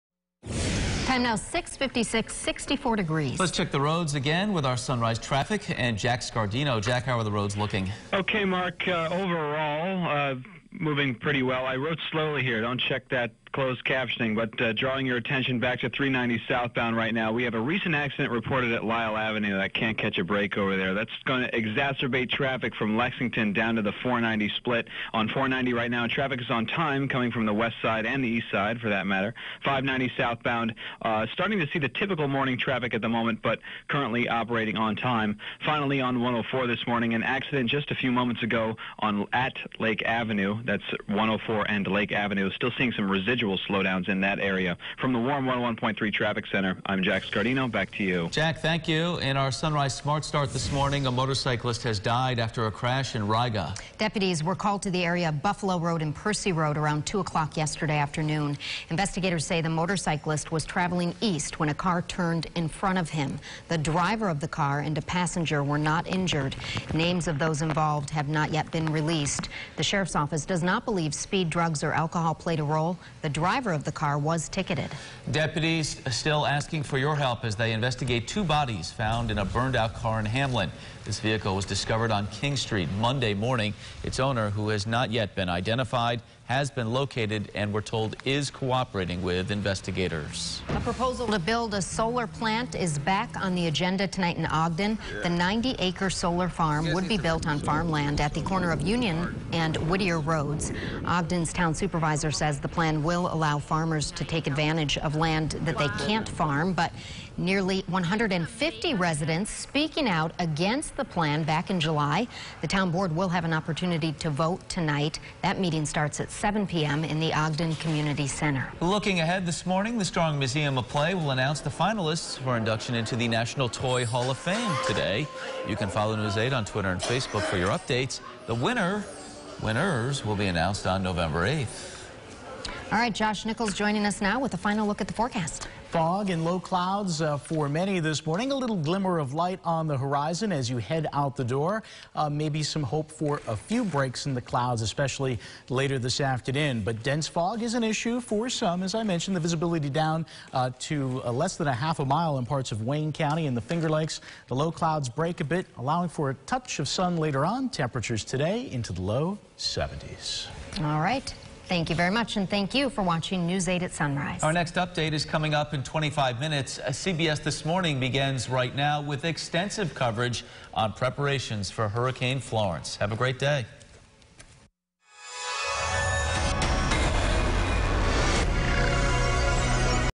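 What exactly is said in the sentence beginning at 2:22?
Uh, maybe some hope for a few breaks in the clouds, especially later this afternoon.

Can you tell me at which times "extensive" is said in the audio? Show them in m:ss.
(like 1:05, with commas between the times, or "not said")
2:49.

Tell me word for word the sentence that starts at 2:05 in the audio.
You can follow News 8 on Twitter and Facebook for your updates.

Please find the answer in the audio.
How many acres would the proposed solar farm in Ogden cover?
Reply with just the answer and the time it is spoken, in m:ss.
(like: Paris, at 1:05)
90, at 1:35.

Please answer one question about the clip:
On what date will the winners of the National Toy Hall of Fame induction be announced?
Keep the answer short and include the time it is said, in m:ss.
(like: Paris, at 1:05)
November 8th, at 2:11.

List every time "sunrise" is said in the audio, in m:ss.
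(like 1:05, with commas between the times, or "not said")
0:04, 0:49, 2:43.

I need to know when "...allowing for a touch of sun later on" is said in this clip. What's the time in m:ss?
2:35.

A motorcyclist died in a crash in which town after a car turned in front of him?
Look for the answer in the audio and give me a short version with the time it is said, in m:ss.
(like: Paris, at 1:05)
Riga, at 0:53.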